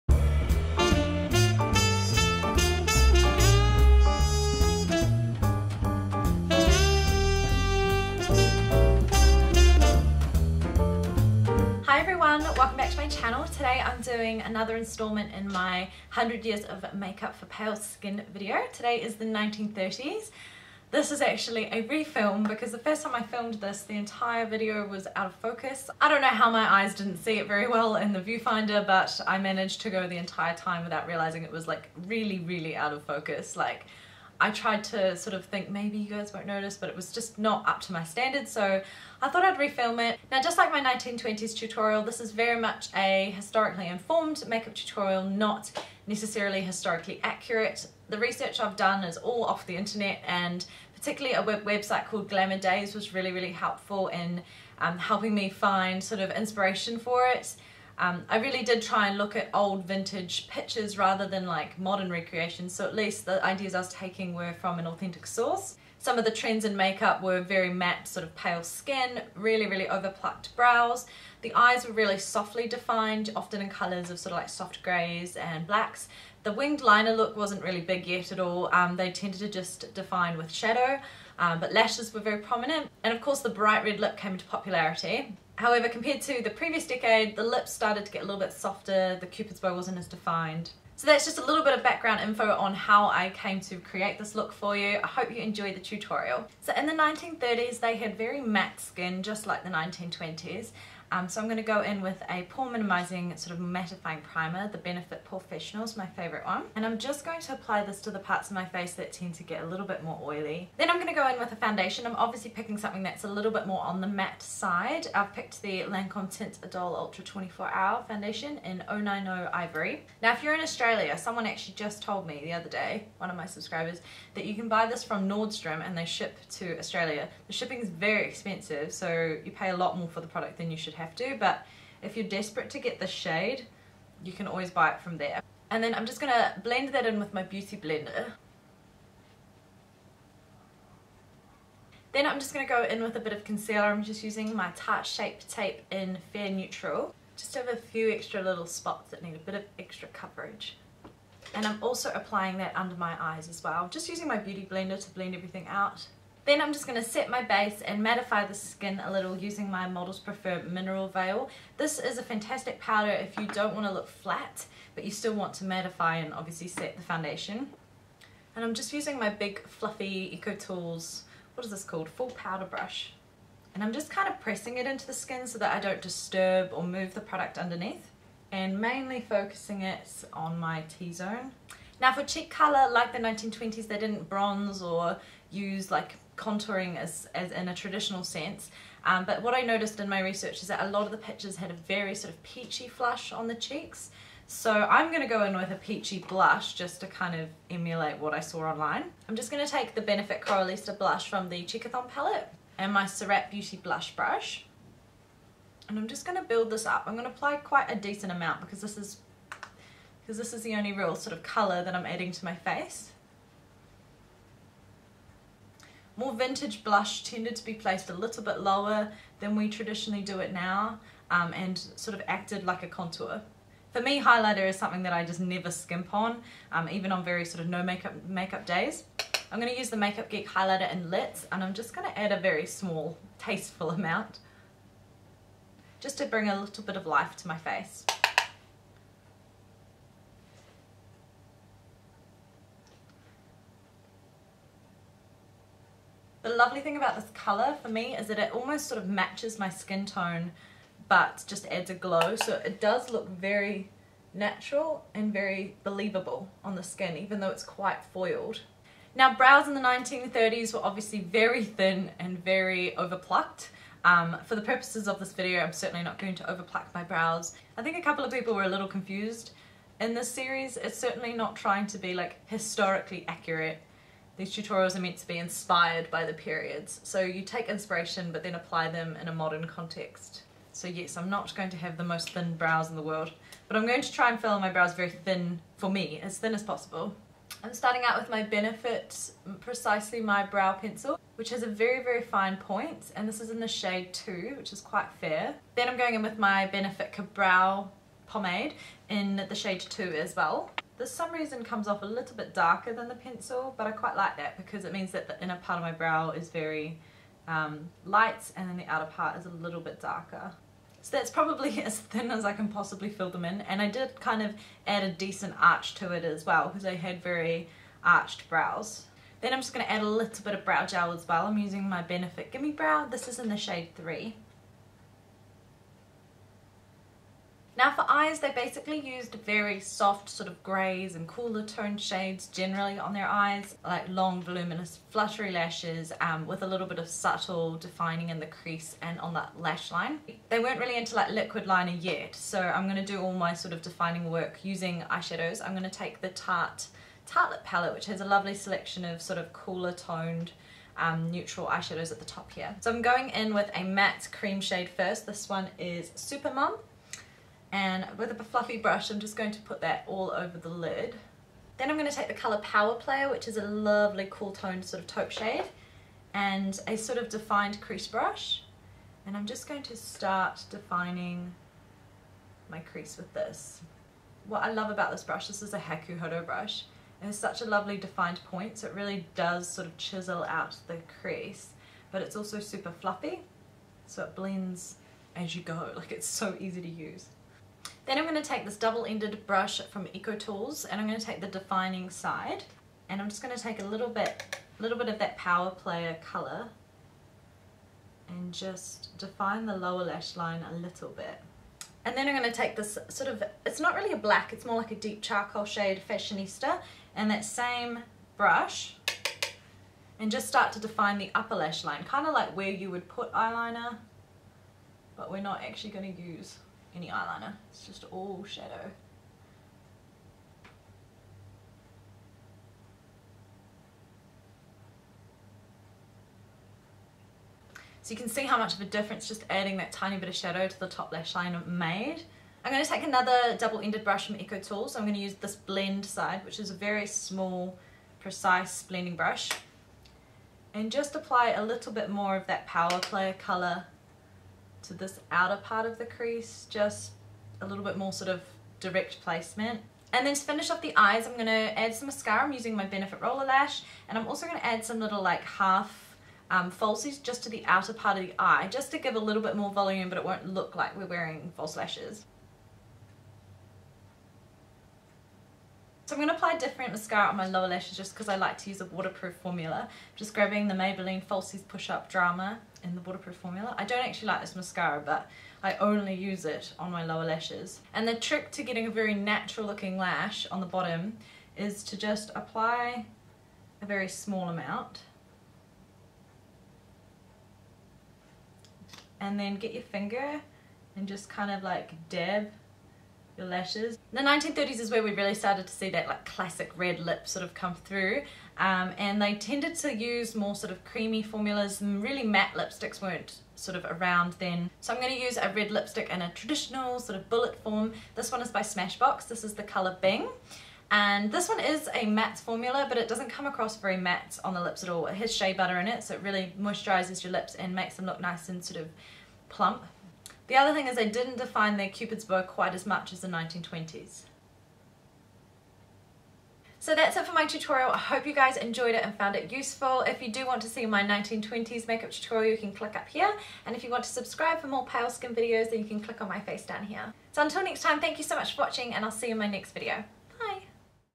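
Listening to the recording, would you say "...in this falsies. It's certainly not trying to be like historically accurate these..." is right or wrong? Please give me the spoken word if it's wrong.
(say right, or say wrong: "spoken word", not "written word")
wrong: "series", not "falsies".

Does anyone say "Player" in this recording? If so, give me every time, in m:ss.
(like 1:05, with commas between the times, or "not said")
6:02, 6:35, 7:23.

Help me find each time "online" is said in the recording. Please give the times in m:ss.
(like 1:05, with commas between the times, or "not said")
3:18.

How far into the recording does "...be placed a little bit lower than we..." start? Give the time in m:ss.
3:37.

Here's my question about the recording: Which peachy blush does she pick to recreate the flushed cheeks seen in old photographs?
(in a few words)
Coralista.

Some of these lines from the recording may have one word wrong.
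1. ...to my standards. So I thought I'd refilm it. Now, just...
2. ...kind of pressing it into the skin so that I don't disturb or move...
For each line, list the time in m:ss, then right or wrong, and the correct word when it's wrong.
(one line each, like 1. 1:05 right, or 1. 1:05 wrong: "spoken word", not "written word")
1. 0:37 right
2. 2:54 right.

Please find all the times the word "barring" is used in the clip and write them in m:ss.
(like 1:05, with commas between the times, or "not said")
not said.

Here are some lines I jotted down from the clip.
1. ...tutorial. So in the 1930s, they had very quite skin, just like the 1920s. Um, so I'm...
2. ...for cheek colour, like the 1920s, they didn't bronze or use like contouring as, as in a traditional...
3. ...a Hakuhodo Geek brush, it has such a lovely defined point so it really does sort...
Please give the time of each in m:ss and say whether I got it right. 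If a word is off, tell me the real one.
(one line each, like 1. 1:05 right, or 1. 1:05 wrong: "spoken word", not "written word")
1. 1:35 wrong: "matte", not "quite"
2. 3:02 right
3. 6:15 wrong: "Hodo", not "Geek".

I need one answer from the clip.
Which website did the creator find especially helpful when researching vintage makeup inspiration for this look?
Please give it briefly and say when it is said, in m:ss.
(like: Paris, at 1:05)
Glamour Daze, at 0:52.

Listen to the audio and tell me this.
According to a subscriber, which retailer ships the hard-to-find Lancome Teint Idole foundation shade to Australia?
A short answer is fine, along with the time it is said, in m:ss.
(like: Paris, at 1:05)
Nordstrom, at 2:05.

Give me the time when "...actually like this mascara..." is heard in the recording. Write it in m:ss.
7:54.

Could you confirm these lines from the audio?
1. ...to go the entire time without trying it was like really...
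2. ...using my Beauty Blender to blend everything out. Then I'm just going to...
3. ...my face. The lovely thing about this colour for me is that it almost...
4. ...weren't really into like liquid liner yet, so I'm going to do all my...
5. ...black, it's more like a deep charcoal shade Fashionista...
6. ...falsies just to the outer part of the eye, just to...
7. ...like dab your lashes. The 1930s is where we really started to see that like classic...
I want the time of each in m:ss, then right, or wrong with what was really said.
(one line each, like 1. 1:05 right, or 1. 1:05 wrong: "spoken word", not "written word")
1. 0:29 wrong: "realizing", not "trying"
2. 2:34 right
3. 3:57 right
4. 5:40 right
5. 6:44 right
6. 7:36 right
7. 8:11 right.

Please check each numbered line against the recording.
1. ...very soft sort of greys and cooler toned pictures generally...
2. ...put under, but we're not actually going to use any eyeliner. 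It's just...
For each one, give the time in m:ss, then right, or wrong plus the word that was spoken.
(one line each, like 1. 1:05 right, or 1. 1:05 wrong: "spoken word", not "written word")
1. 5:29 wrong: "shades", not "pictures"
2. 6:53 wrong: "eyeliner", not "under".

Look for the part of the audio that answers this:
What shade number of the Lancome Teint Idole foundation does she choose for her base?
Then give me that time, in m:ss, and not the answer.
1:58.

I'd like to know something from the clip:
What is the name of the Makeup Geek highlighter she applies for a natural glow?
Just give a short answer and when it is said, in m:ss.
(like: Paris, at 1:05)
Lit, at 3:51.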